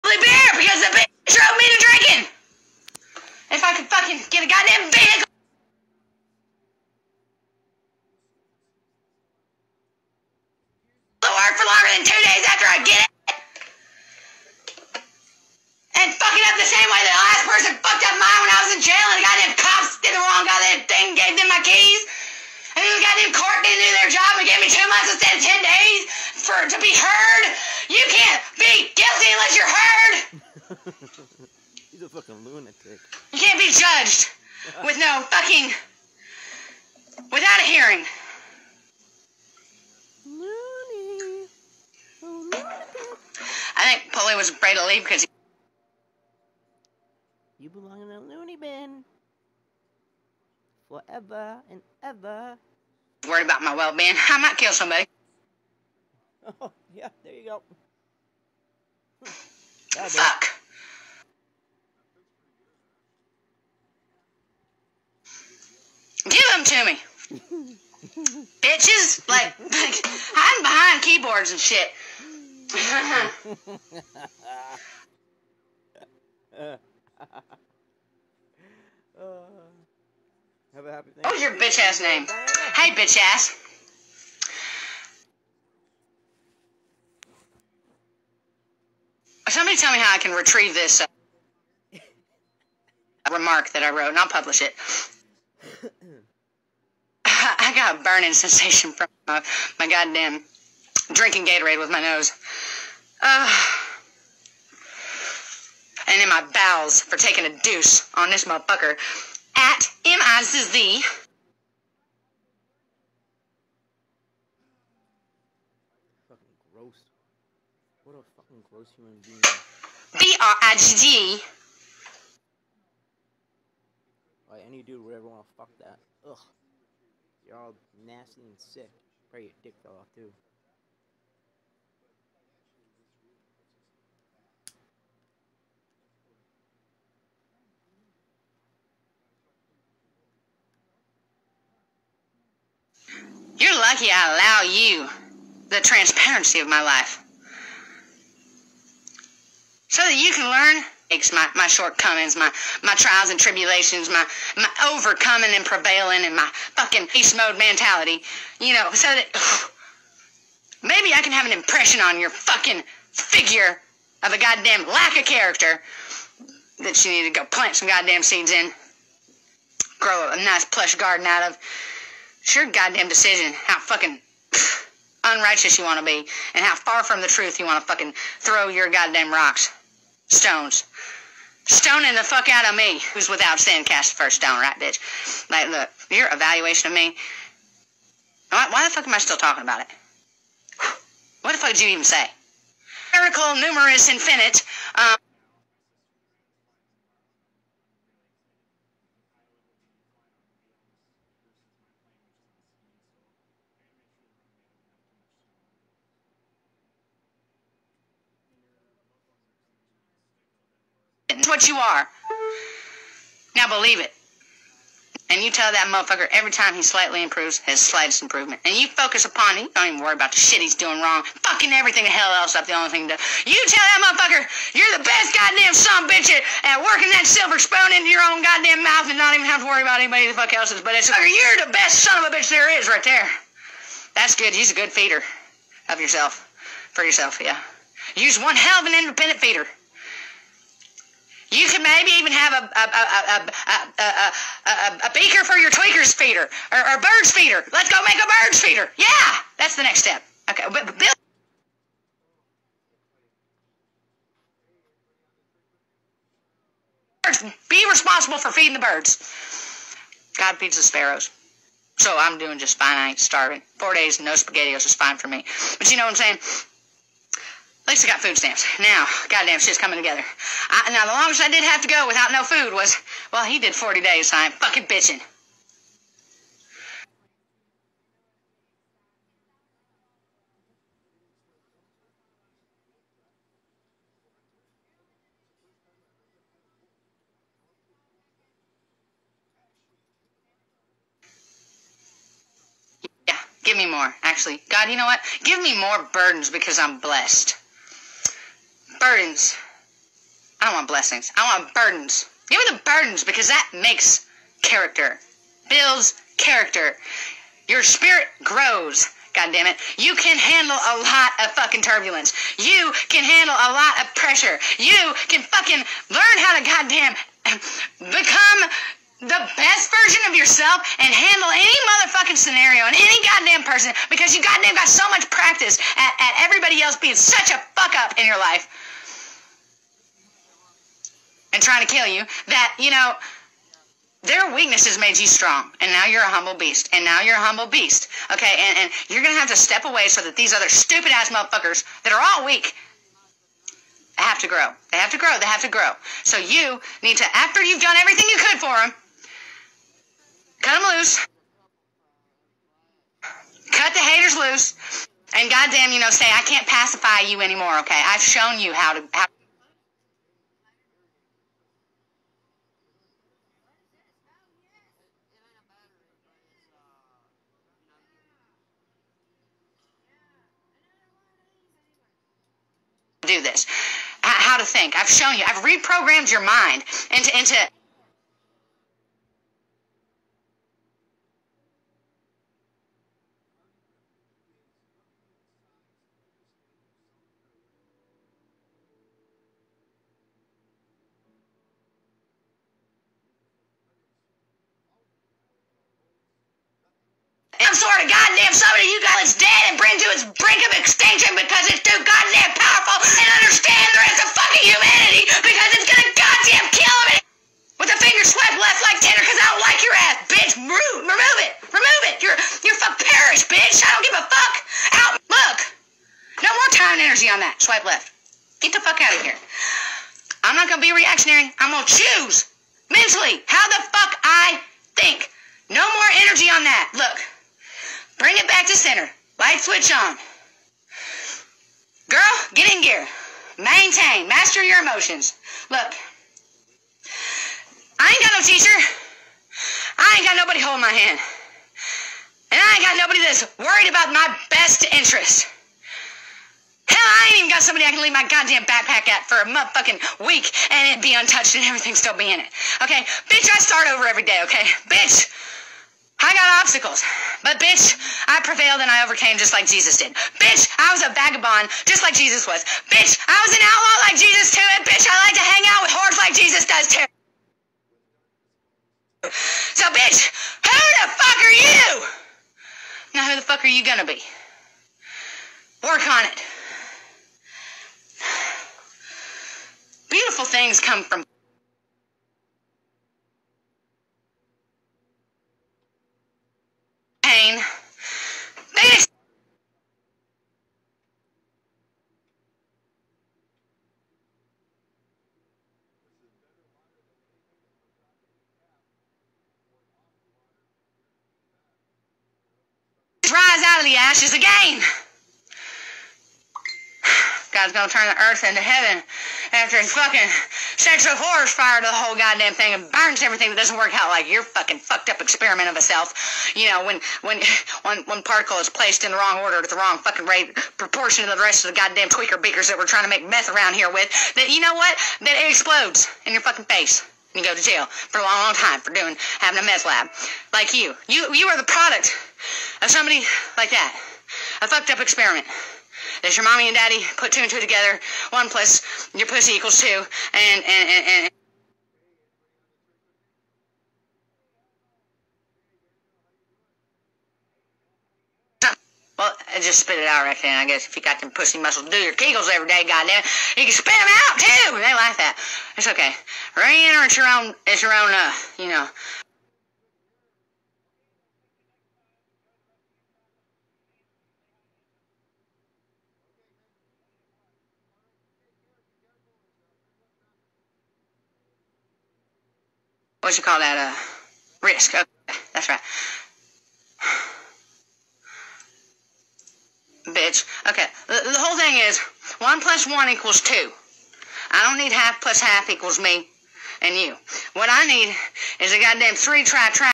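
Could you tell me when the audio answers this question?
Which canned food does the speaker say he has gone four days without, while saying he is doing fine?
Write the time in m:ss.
4:24.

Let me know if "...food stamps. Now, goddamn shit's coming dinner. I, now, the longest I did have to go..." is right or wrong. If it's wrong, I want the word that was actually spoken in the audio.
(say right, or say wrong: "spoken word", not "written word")
wrong: "together", not "dinner".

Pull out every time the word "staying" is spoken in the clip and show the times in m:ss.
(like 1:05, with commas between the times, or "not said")
not said.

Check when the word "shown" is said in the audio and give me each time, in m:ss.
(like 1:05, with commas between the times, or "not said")
5:58, 6:15.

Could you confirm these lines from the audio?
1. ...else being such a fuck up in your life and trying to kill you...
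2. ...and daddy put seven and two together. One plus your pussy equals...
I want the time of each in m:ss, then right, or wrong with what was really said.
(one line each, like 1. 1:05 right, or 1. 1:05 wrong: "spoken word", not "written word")
1. 5:26 right
2. 8:56 wrong: "two", not "seven".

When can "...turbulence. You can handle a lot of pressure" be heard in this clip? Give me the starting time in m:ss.
5:11.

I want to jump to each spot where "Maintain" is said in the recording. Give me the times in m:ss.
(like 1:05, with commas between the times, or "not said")
7:13.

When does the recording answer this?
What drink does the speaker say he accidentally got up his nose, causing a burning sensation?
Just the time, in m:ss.
1:41.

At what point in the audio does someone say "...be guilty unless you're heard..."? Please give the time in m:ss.
0:28.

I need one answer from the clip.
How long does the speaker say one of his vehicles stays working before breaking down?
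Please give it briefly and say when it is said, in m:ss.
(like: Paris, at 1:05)
2 days, at 0:12.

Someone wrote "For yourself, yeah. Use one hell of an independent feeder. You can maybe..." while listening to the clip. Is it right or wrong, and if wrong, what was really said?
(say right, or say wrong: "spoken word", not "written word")
right.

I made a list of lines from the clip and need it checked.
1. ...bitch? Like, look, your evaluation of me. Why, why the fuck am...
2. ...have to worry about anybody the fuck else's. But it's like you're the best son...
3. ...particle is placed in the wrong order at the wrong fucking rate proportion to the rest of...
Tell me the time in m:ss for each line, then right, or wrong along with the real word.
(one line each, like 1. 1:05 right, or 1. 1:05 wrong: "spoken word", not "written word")
1. 3:04 right
2. 3:49 right
3. 8:38 right.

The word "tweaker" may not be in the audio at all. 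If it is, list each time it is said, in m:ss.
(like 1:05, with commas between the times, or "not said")
4:05, 8:42.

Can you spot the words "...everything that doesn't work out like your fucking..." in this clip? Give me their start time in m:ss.
8:33.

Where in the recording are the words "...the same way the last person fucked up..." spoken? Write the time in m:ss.
0:16.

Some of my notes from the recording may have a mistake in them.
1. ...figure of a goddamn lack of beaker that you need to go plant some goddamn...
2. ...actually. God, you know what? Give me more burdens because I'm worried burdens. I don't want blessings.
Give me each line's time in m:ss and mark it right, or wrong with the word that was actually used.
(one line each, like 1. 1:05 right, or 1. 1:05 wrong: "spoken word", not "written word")
1. 2:43 wrong: "character", not "beaker"
2. 4:54 wrong: "blessed", not "worried".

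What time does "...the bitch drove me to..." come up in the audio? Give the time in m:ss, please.
0:00.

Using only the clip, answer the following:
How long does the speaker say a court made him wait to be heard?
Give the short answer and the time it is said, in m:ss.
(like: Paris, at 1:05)
2 months, at 0:24.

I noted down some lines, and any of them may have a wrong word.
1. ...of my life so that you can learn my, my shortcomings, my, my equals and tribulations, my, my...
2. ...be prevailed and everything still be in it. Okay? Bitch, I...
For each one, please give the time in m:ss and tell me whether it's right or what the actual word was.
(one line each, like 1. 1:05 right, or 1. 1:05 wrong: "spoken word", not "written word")
1. 2:26 wrong: "trials", not "equals"
2. 7:31 wrong: "untouched", not "prevailed".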